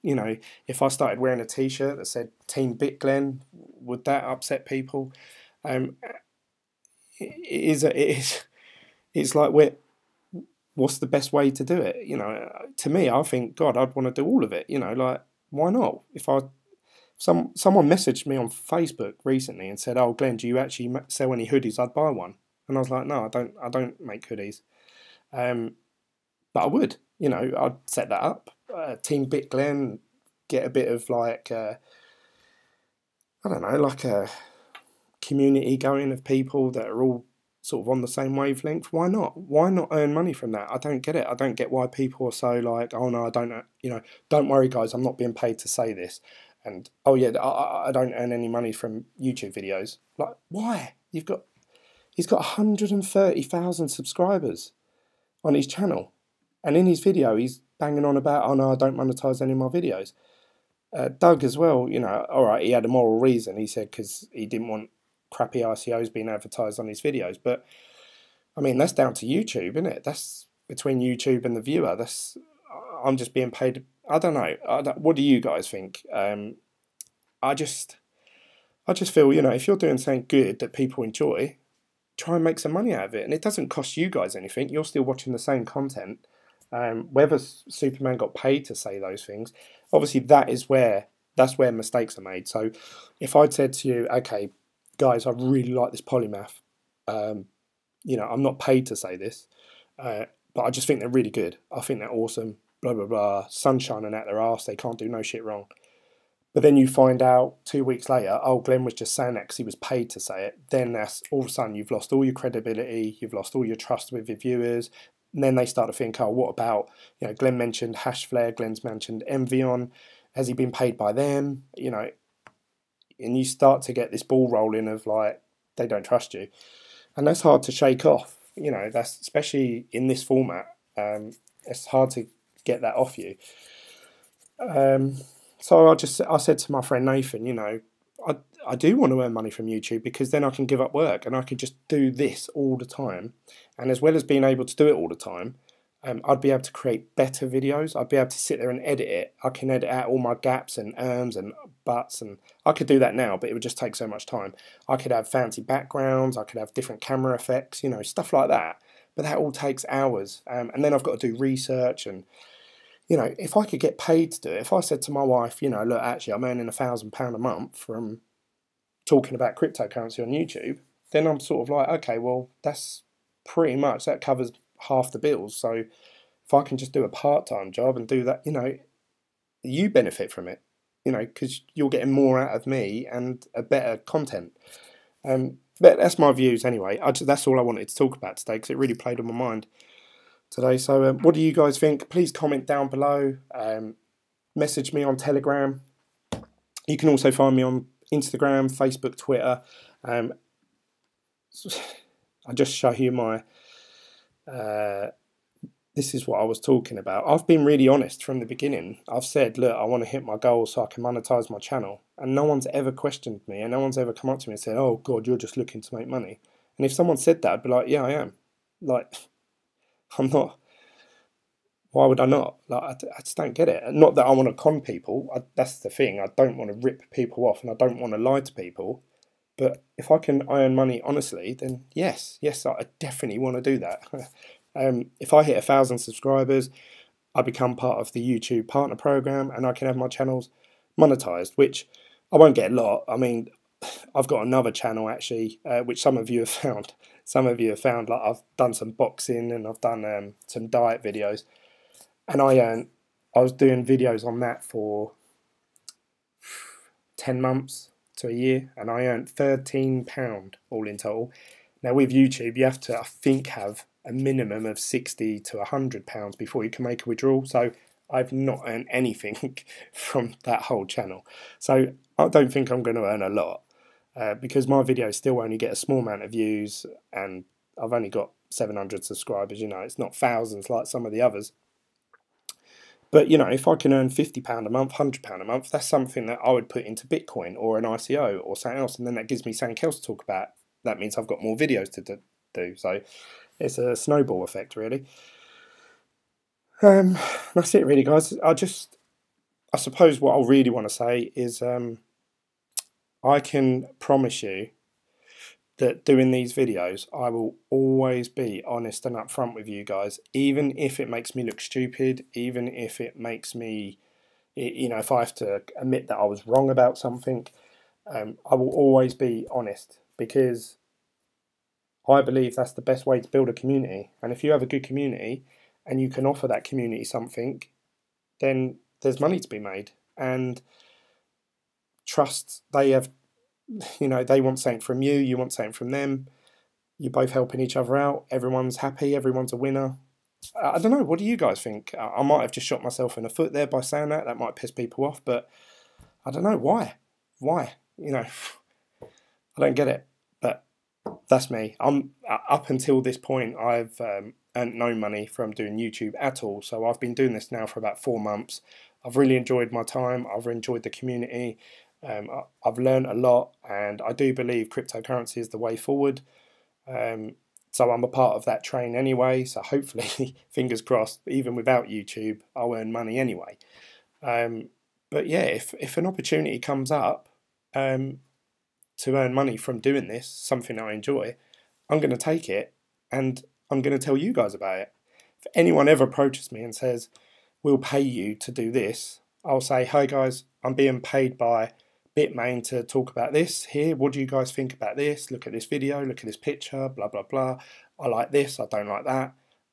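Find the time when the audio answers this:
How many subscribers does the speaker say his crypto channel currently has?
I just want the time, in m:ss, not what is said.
4:38.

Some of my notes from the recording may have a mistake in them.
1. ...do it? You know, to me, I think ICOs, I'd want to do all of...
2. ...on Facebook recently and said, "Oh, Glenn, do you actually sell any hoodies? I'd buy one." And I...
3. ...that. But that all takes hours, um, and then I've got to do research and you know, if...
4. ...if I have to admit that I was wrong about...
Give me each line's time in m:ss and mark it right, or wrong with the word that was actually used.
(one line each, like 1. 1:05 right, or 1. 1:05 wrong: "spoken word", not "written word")
1. 0:11 wrong: "God", not "ICOs"
2. 0:18 right
3. 2:38 right
4. 5:14 right.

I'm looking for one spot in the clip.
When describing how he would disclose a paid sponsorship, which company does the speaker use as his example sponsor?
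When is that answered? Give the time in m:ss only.
6:32.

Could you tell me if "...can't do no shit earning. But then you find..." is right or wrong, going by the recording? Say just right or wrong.
wrong.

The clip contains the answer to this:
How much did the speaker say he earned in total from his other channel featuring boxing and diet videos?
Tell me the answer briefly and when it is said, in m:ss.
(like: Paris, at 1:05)
£13, at 4:19.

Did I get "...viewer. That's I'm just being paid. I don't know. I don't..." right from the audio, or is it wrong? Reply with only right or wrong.
right.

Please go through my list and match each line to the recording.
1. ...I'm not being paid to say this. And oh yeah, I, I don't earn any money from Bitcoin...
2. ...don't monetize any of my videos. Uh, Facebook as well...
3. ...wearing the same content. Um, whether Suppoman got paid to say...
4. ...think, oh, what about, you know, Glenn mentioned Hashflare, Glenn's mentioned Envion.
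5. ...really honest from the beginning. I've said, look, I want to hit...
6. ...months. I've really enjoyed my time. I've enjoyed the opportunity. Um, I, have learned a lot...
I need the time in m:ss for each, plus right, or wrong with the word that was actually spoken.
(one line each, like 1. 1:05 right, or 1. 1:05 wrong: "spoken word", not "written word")
1. 0:44 wrong: "YouTube", not "Bitcoin"
2. 0:58 wrong: "Doug", not "Facebook"
3. 1:25 wrong: "watching", not "wearing"
4. 1:55 right
5. 3:27 right
6. 5:58 wrong: "community", not "opportunity".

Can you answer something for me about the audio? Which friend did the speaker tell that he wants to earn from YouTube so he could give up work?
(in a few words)
Nathan.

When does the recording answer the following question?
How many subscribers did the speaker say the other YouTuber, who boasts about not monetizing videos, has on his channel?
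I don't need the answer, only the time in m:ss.
0:52.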